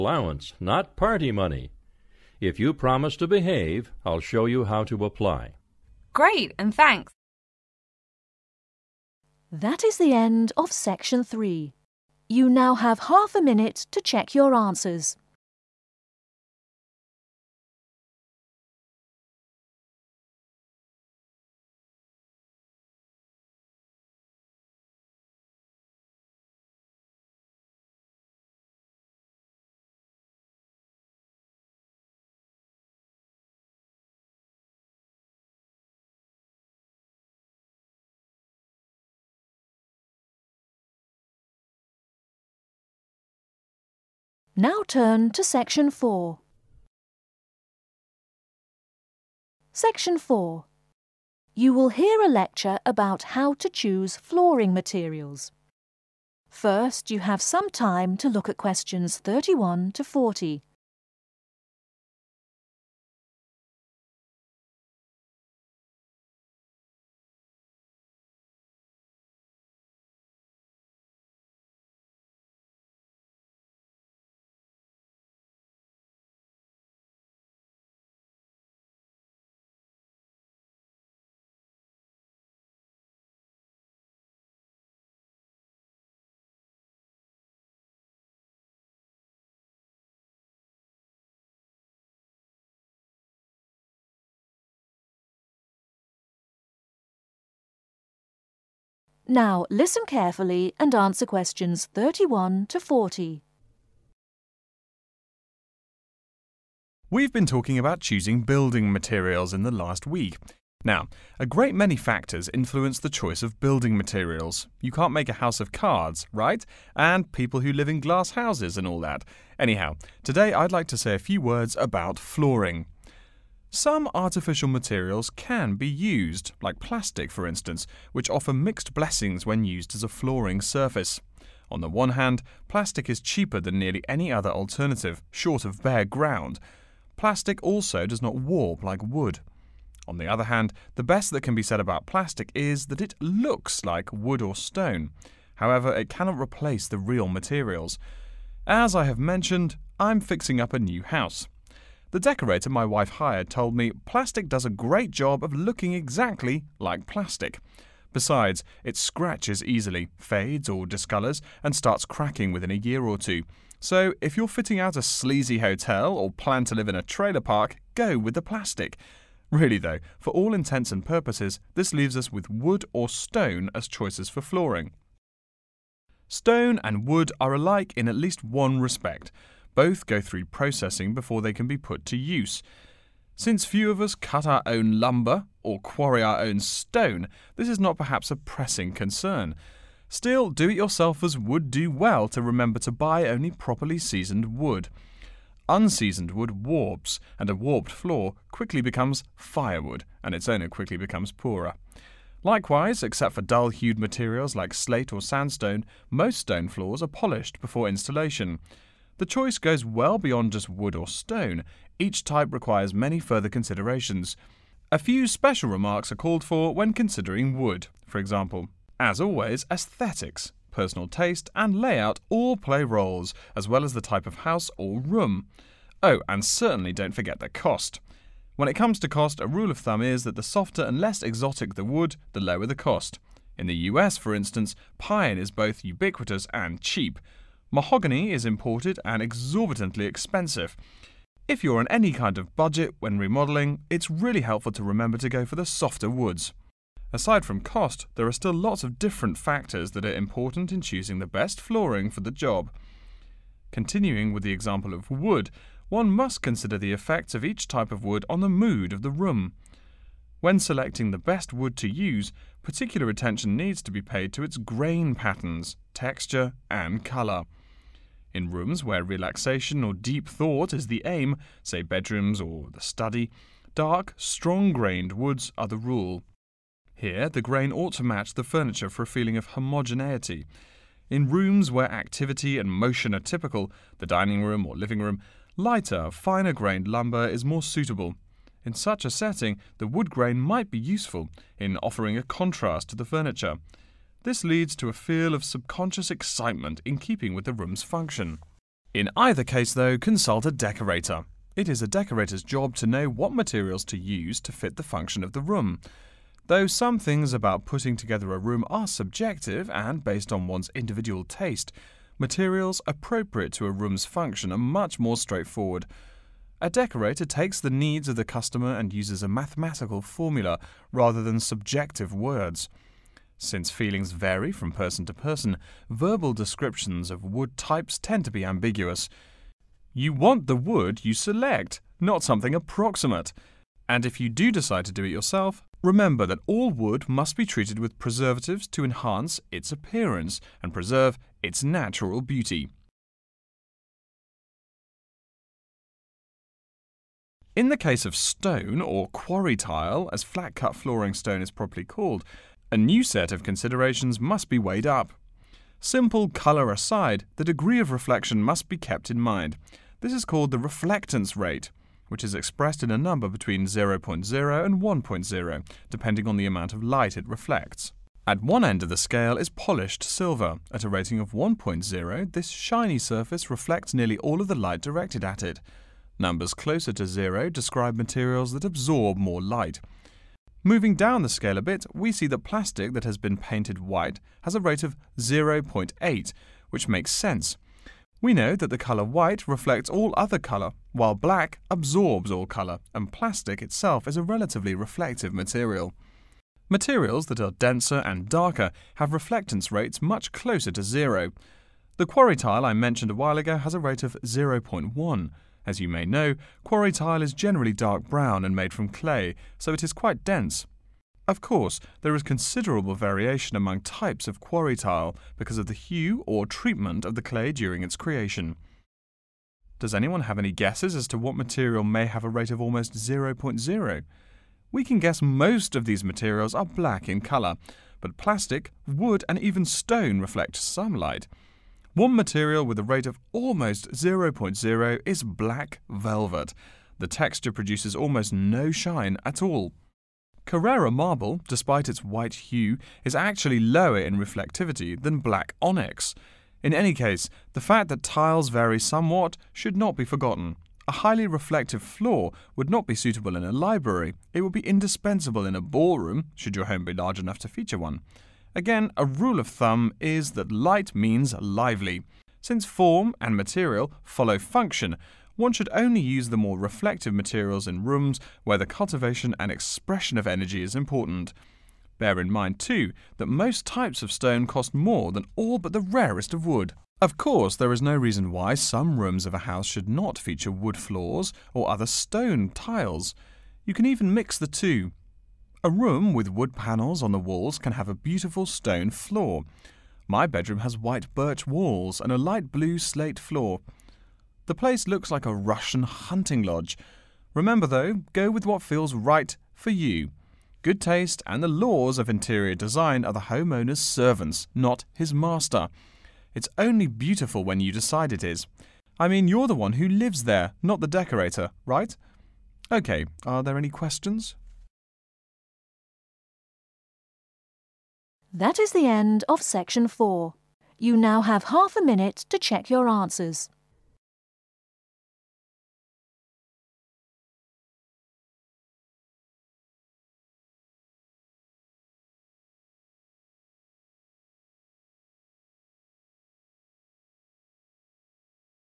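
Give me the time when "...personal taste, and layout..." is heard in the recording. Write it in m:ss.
3:40.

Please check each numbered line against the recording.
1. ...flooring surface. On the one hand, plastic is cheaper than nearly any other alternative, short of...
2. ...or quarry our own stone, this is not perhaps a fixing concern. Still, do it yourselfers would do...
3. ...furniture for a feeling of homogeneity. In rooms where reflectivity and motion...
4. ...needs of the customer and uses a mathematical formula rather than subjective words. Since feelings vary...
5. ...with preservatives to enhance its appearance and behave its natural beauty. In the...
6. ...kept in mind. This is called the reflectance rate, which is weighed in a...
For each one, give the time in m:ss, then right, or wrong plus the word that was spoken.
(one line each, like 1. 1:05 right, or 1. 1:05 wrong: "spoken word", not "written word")
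1. 2:10 right
2. 3:05 wrong: "pressing", not "fixing"
3. 4:38 wrong: "activity", not "reflectivity"
4. 5:17 right
5. 5:37 wrong: "preserve", not "behave"
6. 5:58 wrong: "expressed", not "weighed".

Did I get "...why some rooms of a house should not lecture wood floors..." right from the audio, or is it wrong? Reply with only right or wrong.
wrong.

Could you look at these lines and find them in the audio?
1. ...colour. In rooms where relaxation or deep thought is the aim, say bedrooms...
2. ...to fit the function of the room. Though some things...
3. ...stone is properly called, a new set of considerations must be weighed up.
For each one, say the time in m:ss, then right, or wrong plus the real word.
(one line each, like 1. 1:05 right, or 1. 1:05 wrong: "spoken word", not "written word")
1. 4:27 right
2. 5:04 right
3. 5:51 right.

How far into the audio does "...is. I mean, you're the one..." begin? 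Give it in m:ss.
8:28.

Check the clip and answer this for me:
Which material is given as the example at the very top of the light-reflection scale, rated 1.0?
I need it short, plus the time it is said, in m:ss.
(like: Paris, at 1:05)
polished silver, at 6:09.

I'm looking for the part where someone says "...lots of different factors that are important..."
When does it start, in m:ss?
4:08.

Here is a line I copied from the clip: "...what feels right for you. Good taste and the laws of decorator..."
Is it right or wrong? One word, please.
wrong.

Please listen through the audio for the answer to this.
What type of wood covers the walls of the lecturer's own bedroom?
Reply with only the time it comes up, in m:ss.
8:10.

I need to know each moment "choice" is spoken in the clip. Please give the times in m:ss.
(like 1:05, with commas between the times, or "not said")
1:53, 2:53, 3:29.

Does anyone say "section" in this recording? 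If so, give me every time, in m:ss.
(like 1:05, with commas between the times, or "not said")
0:10, 0:45, 0:49, 8:39.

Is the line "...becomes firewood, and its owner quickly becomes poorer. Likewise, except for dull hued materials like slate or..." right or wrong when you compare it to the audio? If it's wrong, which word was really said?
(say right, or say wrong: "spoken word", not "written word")
right.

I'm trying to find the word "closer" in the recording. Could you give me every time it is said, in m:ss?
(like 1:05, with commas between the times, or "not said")
6:16, 6:40.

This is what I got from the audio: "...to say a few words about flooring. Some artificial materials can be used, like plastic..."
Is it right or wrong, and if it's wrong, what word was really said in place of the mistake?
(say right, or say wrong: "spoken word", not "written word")
right.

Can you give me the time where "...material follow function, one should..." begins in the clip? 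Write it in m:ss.
7:43.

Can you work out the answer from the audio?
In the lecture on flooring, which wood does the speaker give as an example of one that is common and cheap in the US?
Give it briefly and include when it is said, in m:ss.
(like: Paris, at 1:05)
pine, at 3:54.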